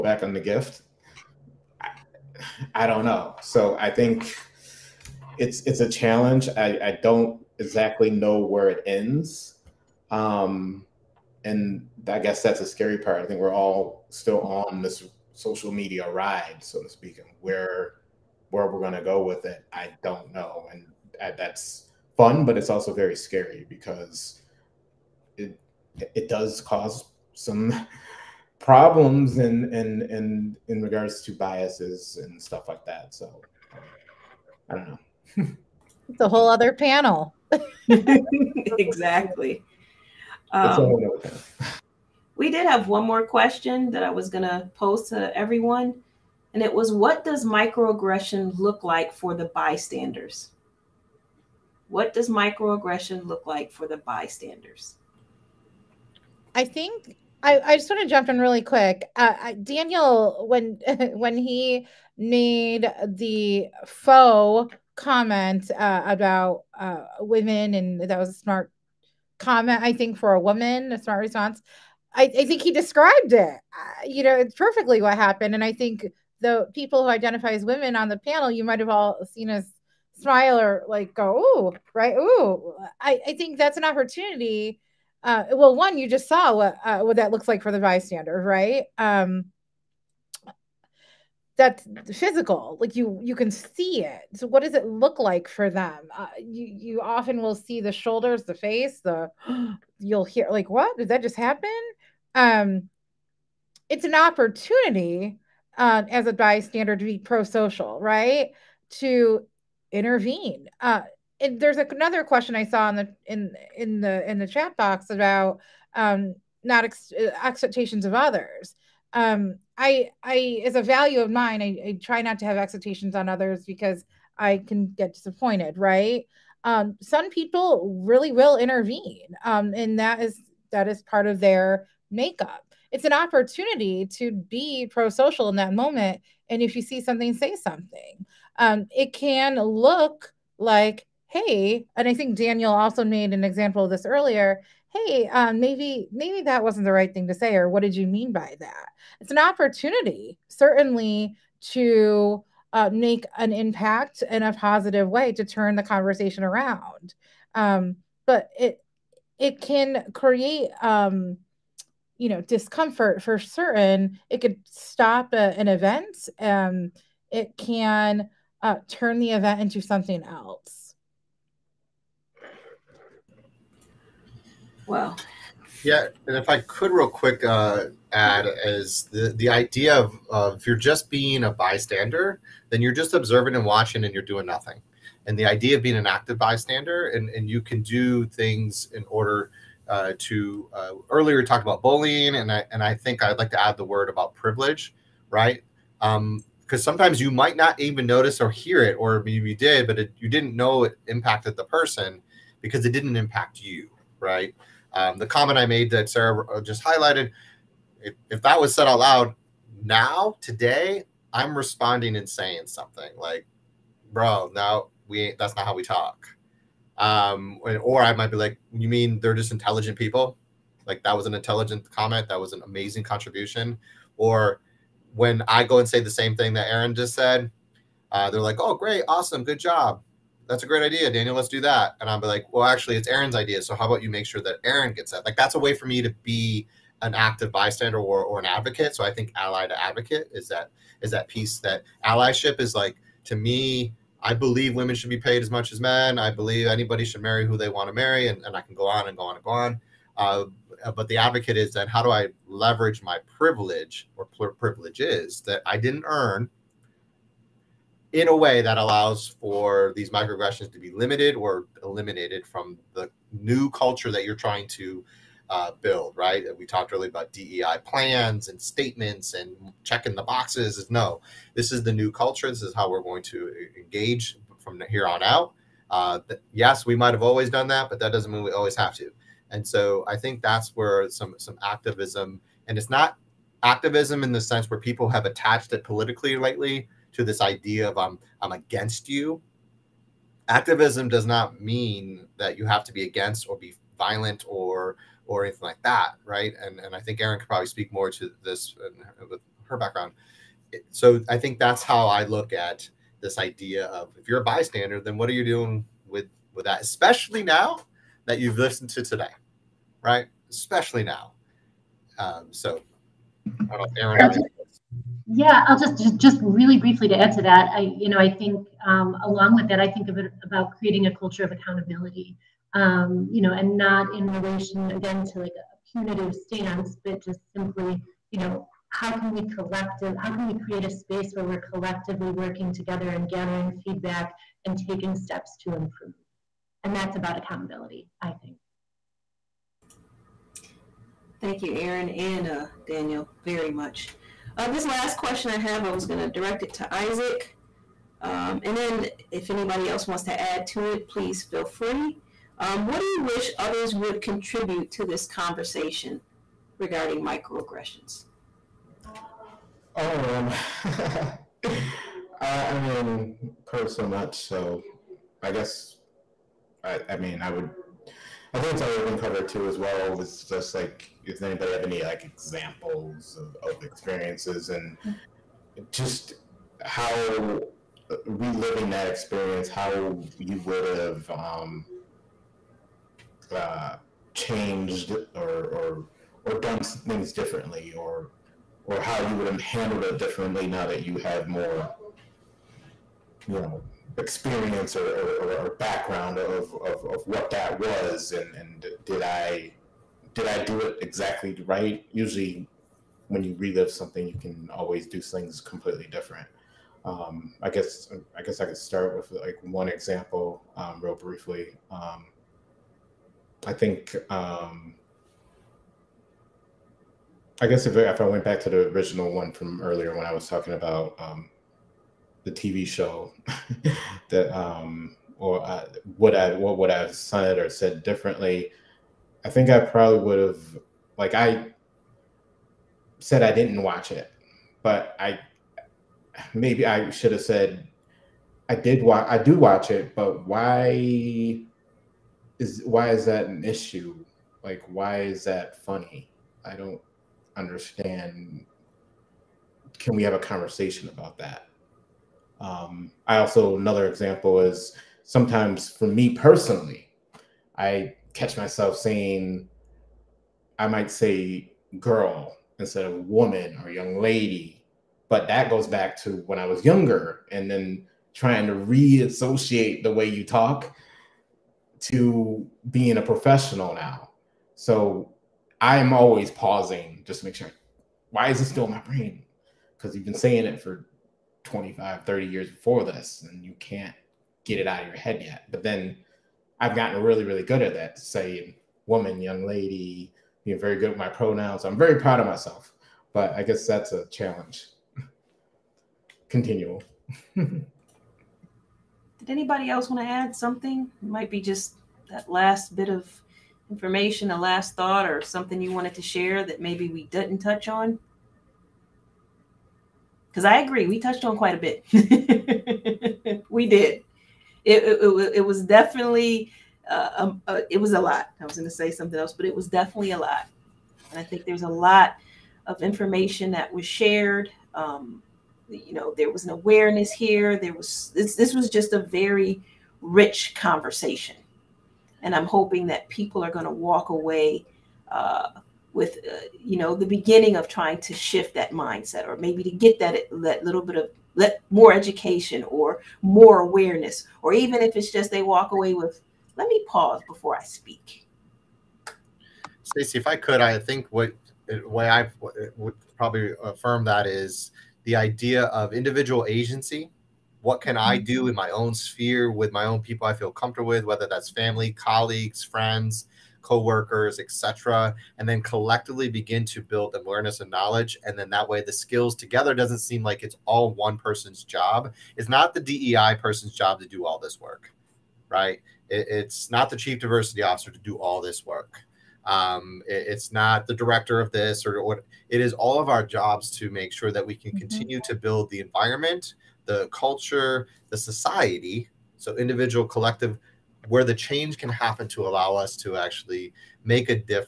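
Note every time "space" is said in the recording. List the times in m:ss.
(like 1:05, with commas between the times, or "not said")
5:30.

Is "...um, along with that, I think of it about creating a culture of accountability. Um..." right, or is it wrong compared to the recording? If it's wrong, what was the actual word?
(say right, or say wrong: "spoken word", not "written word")
right.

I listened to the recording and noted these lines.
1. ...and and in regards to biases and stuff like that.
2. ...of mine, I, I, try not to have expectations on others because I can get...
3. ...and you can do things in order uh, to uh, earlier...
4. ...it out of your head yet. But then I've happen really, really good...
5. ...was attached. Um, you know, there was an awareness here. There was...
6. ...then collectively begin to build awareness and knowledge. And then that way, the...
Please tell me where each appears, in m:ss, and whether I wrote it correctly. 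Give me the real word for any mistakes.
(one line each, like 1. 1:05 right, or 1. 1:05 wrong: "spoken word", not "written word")
1. 0:29 right
2. 2:01 right
3. 3:07 right
4. 8:04 wrong: "gotten", not "happen"
5. 8:43 wrong: "shared", not "attached"
6. 9:25 right.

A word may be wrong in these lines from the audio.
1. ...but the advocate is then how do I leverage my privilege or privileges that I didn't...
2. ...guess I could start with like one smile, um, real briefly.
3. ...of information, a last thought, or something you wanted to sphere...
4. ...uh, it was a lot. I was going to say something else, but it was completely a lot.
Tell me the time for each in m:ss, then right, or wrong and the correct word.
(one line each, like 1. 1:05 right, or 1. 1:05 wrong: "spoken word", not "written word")
1. 4:10 right
2. 6:48 wrong: "example", not "smile"
3. 8:23 wrong: "share", not "sphere"
4. 8:37 wrong: "definitely", not "completely".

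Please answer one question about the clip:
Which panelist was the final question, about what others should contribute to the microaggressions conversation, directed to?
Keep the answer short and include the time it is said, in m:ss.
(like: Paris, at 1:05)
Isaac, at 5:46.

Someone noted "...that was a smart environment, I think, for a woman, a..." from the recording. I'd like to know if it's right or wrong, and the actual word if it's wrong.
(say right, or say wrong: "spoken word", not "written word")
wrong: "comment", not "environment".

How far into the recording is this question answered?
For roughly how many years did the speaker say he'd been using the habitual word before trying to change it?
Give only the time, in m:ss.
8:01.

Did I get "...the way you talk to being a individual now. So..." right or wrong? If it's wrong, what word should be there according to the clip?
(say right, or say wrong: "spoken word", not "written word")
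wrong: "professional", not "individual".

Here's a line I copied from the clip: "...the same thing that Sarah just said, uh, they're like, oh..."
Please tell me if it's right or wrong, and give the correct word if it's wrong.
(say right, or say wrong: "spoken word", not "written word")
wrong: "Aaron", not "Sarah".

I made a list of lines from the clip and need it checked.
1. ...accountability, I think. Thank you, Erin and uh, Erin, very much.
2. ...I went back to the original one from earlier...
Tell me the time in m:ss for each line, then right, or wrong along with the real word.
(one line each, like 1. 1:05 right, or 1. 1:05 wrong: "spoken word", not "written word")
1. 5:37 wrong: "Daniel", not "Erin"
2. 6:58 right.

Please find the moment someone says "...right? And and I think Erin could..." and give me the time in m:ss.
4:56.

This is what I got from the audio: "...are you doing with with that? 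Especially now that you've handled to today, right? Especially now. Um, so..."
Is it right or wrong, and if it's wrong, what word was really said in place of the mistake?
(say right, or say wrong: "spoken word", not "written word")
wrong: "listened", not "handled".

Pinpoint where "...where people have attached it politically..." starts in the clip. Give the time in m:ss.
4:44.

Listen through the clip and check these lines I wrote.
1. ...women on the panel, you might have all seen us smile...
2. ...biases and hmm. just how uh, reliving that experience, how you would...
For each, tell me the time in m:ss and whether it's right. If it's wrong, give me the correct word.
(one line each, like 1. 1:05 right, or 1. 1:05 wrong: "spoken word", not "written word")
1. 1:17 right
2. 6:13 wrong: "experiences", not "biases".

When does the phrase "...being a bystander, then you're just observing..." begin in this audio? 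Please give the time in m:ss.
3:01.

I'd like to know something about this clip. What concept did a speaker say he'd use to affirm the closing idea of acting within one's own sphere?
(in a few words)
individual agency.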